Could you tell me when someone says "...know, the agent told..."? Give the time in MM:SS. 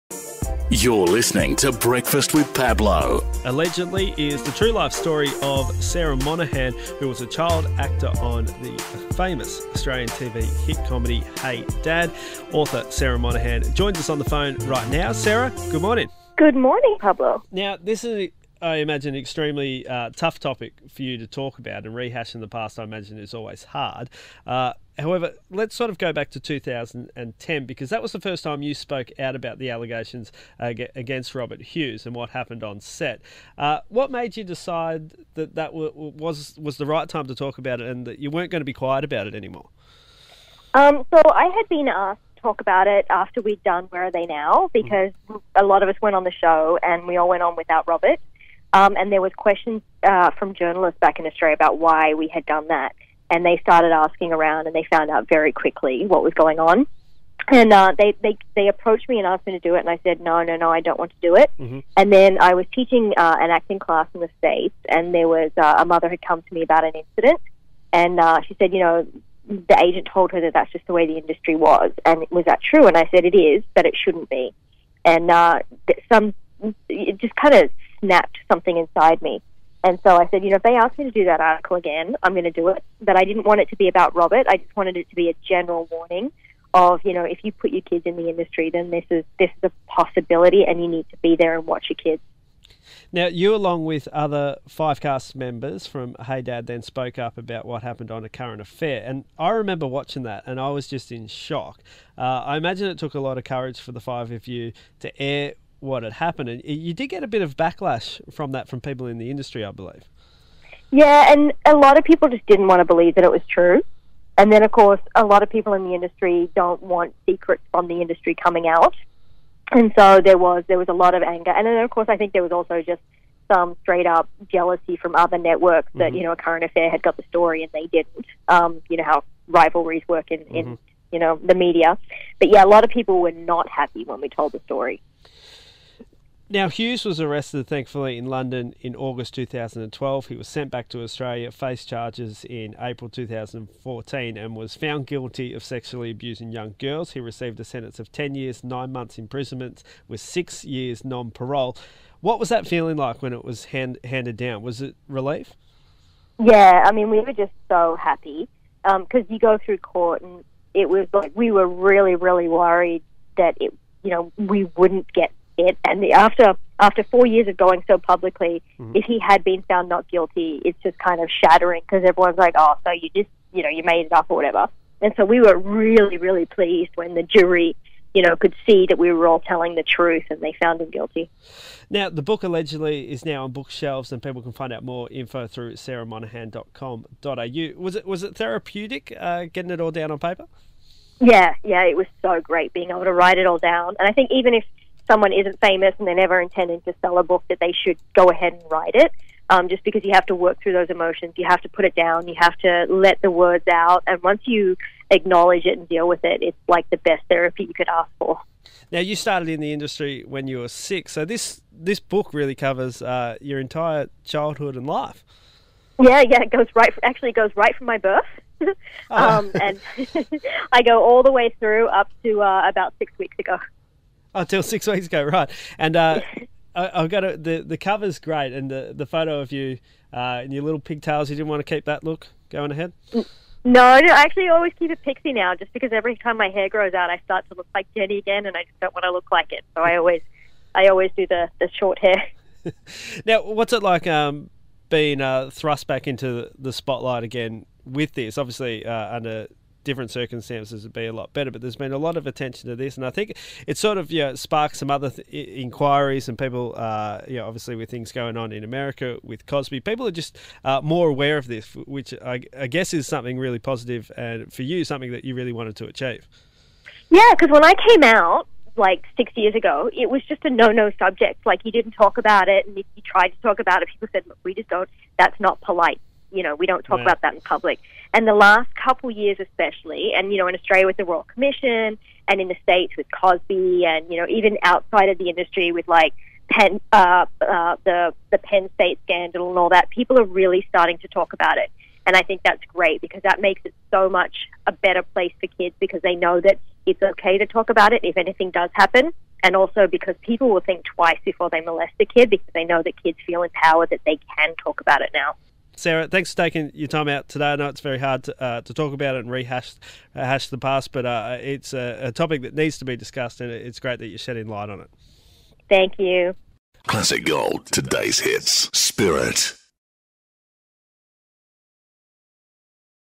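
01:08.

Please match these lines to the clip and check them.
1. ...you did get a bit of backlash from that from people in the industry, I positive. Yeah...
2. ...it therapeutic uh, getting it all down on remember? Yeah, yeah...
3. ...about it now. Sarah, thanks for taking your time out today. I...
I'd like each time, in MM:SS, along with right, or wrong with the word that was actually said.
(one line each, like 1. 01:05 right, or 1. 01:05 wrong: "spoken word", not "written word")
1. 01:46 wrong: "believe", not "positive"
2. 03:08 wrong: "paper", not "remember"
3. 05:04 right.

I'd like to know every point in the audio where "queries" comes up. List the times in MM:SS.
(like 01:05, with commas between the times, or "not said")
not said.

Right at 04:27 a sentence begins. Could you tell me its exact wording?
Yeah, because when I came out, like six years ago, it was just a no-no subject.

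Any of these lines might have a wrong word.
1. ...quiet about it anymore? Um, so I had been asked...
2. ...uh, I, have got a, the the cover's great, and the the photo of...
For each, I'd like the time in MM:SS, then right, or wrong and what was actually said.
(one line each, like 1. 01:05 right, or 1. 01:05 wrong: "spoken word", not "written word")
1. 00:38 right
2. 03:45 right.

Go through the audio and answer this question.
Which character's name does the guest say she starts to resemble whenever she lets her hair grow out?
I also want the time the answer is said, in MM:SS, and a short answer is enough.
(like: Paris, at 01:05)
Jenny, at 03:57.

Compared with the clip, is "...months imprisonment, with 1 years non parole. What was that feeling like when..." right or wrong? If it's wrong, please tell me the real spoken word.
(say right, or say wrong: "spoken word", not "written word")
wrong: "6", not "1".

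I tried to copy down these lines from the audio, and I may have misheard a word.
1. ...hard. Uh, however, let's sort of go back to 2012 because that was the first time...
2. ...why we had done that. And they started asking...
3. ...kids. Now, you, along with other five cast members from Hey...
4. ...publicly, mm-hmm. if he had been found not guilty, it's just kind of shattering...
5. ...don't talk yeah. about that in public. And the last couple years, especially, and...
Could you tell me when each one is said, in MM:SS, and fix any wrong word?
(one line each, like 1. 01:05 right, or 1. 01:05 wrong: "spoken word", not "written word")
1. 00:23 wrong: "2010", not "2012"
2. 00:51 right
3. 01:31 right
4. 02:47 right
5. 04:36 right.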